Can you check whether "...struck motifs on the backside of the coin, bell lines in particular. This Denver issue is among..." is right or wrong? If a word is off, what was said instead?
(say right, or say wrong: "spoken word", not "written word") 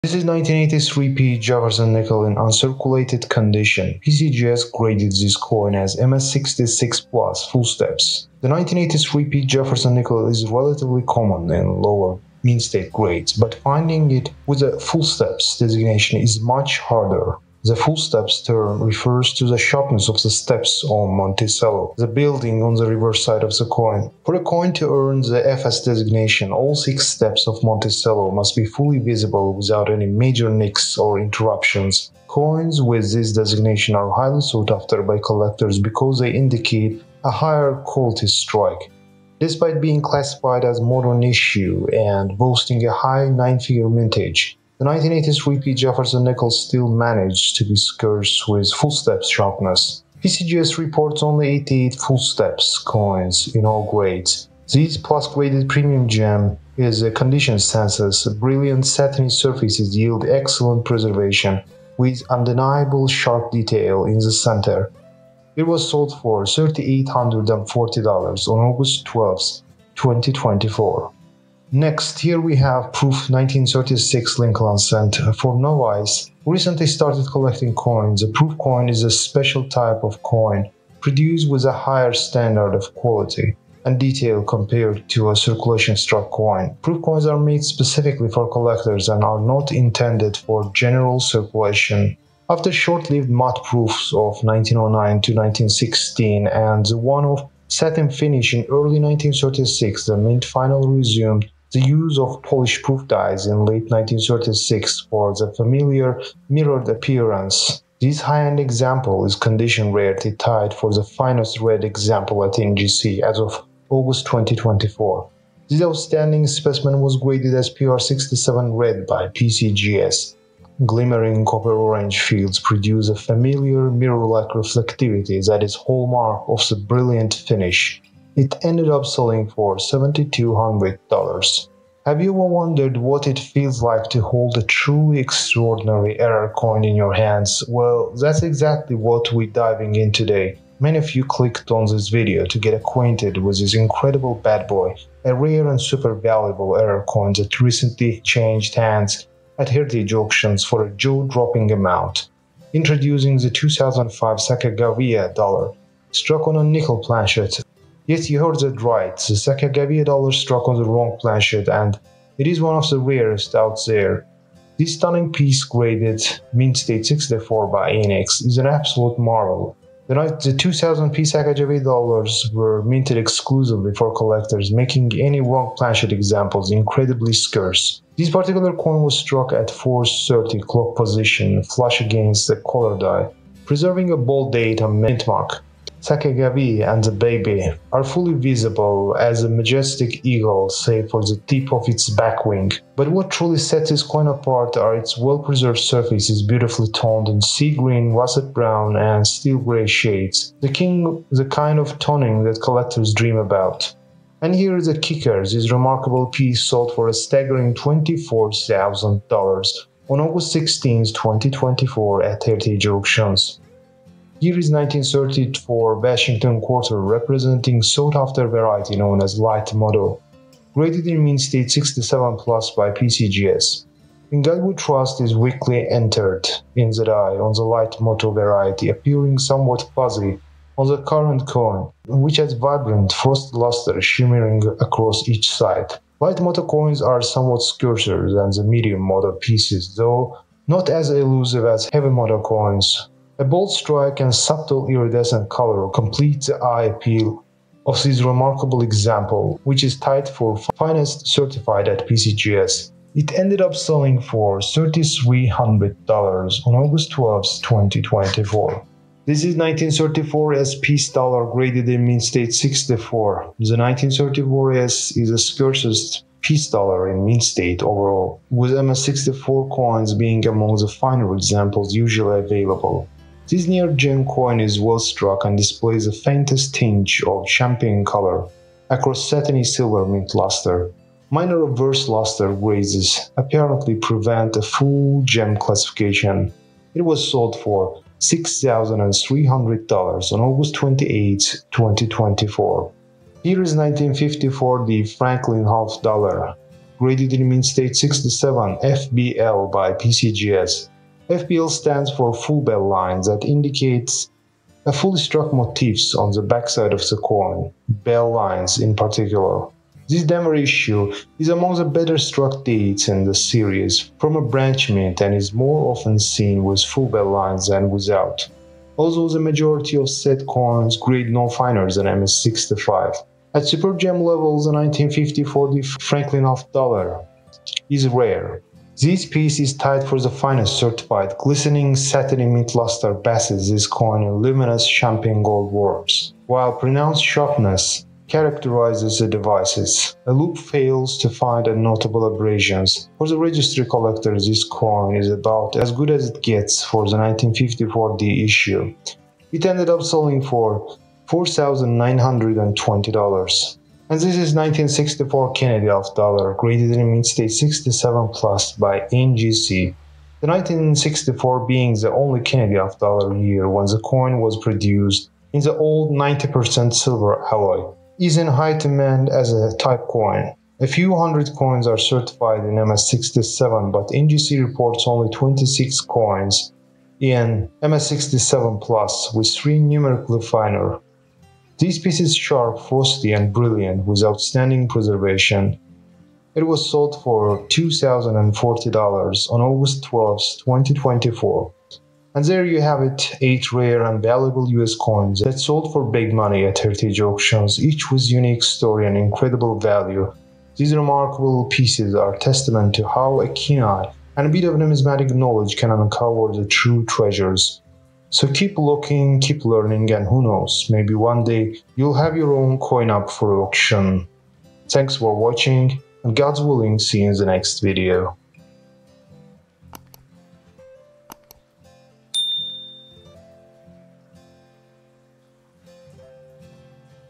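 right.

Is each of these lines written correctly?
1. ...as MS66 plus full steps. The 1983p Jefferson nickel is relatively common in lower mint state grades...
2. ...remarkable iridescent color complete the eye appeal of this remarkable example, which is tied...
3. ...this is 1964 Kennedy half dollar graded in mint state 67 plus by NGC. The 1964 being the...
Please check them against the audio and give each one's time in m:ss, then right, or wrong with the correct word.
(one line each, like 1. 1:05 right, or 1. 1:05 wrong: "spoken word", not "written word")
1. 0:05 right
2. 4:04 wrong: "subtle", not "remarkable"
3. 5:54 right.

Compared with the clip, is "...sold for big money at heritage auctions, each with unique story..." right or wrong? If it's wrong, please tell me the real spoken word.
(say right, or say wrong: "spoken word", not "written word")
right.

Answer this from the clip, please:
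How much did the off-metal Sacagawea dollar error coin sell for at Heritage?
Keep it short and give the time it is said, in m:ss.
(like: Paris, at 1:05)
$24,000, at 3:27.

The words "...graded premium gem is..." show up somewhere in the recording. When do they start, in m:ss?
0:55.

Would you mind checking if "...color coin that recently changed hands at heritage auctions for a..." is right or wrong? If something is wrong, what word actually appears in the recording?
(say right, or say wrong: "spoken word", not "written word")
wrong: "error", not "color".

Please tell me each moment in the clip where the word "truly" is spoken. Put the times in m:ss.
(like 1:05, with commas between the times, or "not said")
2:14, 3:13.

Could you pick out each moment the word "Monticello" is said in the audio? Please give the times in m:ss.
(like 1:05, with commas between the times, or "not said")
0:21, 0:27.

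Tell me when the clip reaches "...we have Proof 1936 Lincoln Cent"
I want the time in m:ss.
1:12.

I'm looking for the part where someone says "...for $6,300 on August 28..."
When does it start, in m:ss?
4:47.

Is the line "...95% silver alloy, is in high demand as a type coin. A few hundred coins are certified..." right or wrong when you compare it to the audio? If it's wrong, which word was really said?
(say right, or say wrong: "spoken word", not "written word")
wrong: "90", not "95".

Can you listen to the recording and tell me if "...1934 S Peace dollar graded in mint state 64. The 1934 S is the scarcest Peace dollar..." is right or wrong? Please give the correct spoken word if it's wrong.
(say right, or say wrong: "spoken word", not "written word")
right.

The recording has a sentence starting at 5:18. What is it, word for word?
Although the majority of set coins grade no finer than MS65.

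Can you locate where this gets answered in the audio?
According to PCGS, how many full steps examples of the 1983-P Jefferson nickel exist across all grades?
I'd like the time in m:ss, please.
0:51.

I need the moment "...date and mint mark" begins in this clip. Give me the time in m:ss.
3:04.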